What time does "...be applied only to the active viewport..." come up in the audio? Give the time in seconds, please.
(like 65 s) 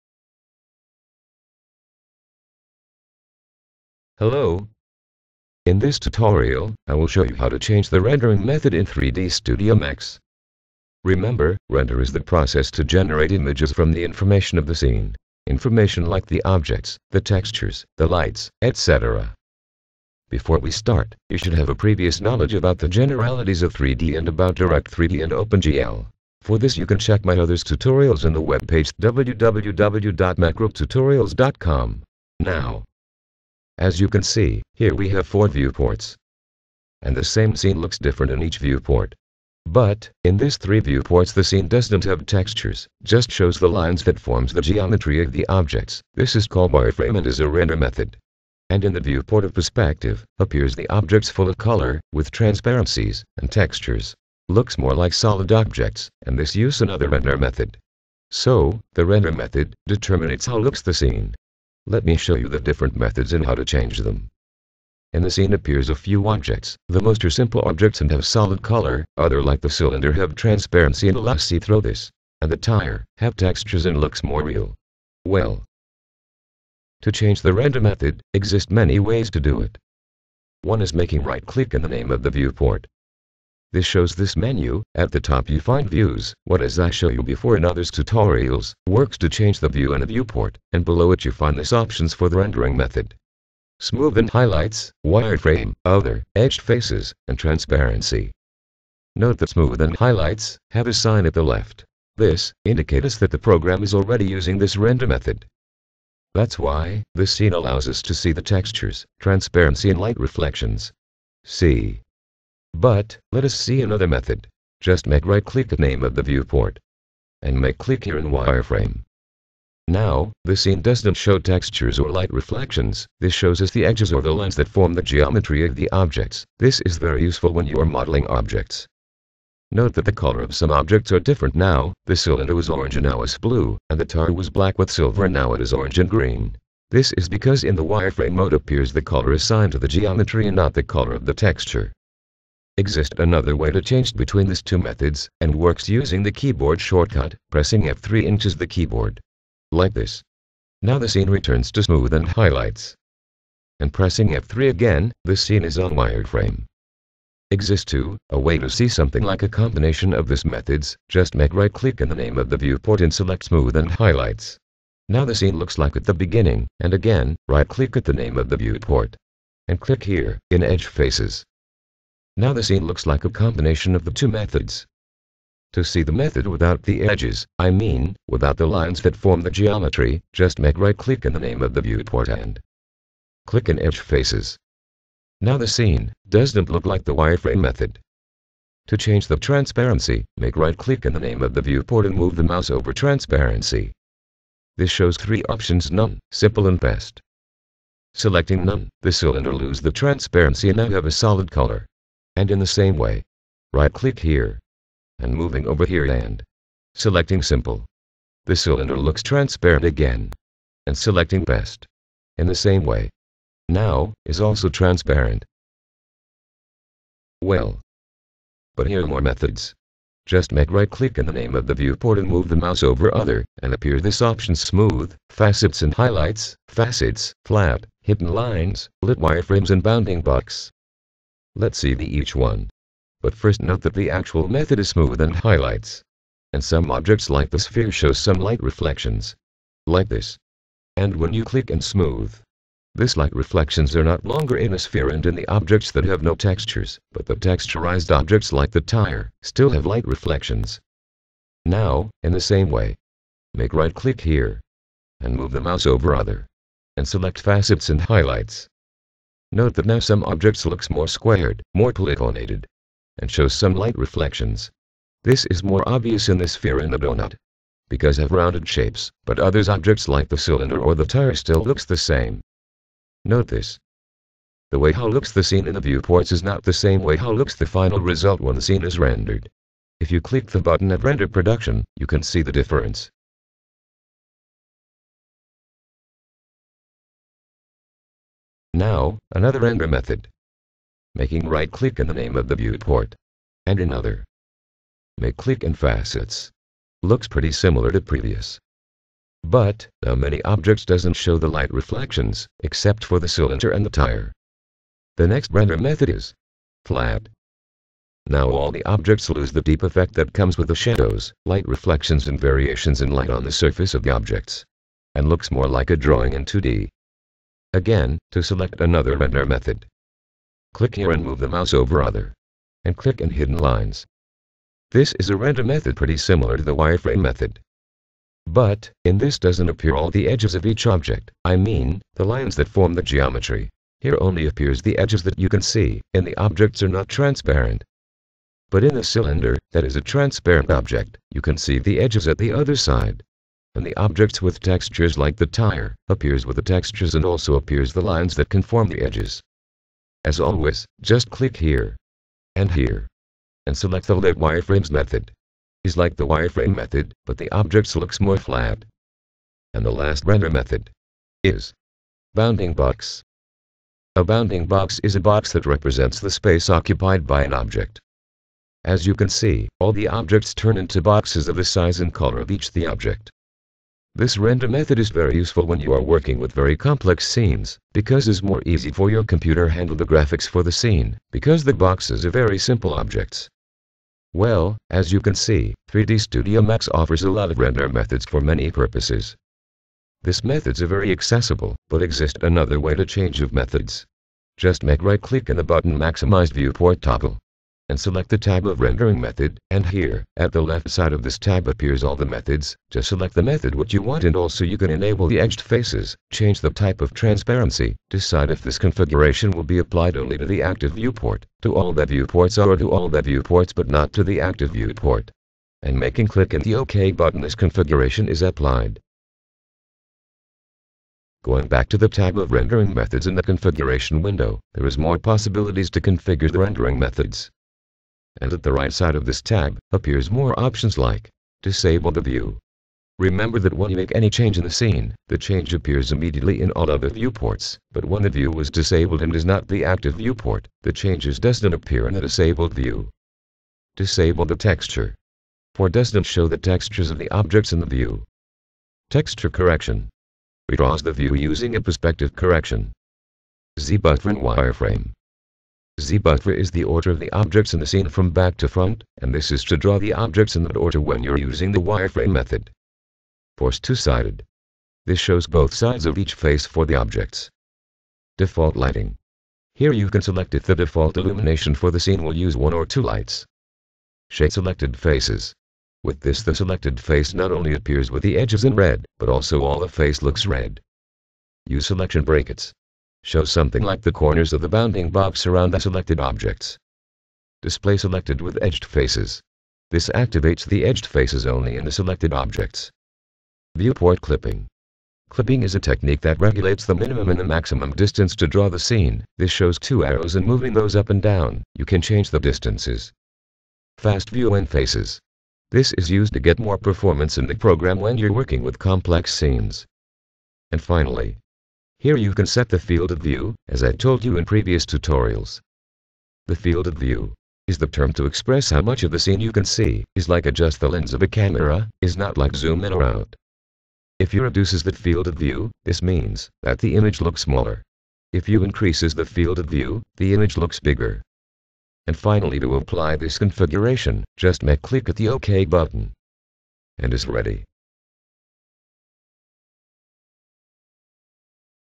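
409 s.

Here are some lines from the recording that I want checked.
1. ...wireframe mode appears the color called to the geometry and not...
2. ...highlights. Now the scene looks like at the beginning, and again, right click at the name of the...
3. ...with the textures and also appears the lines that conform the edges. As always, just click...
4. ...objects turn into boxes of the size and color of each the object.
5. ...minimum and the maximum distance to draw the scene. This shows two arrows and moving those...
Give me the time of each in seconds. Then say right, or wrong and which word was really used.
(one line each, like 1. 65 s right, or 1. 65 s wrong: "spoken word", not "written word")
1. 137 s wrong: "assigned", not "called"
2. 163 s right
3. 346 s right
4. 370 s right
5. 496 s right.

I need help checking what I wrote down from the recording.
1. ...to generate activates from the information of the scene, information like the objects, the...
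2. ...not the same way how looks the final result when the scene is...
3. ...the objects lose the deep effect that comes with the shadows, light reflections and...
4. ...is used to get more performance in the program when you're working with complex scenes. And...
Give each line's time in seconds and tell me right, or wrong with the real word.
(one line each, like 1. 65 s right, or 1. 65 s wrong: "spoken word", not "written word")
1. 12 s wrong: "images", not "activates"
2. 276 s right
3. 308 s right
4. 505 s right.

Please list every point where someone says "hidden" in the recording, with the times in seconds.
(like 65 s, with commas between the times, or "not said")
228 s, 323 s.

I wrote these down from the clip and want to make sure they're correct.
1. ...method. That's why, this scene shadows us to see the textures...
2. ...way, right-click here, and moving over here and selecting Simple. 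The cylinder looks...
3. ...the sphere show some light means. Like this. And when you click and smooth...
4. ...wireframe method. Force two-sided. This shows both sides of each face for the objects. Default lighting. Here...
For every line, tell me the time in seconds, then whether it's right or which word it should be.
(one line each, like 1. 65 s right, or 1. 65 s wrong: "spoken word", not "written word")
1. 105 s wrong: "allows", not "shadows"
2. 202 s right
3. 237 s wrong: "reflections", not "means"
4. 461 s right.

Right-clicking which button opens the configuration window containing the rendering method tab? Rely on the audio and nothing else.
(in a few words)
Maximize Viewport Toggle.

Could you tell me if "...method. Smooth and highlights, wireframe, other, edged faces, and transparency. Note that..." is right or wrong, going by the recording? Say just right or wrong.
right.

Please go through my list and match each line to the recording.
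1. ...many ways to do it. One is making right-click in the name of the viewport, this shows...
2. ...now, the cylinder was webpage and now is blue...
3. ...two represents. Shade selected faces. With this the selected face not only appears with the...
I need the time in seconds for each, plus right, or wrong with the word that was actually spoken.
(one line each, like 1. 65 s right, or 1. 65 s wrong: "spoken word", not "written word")
1. 78 s right
2. 131 s wrong: "orange", not "webpage"
3. 472 s wrong: "lights", not "represents".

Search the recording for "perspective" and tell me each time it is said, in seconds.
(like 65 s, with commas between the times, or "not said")
49 s, 451 s.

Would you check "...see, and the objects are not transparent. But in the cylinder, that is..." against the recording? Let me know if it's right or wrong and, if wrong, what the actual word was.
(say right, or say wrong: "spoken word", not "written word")
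right.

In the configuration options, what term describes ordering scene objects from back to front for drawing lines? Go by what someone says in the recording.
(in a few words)
Z-buffer.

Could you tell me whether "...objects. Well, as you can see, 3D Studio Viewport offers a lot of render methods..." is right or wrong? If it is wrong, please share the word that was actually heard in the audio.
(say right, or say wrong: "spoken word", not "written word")
wrong: "Max", not "Viewport".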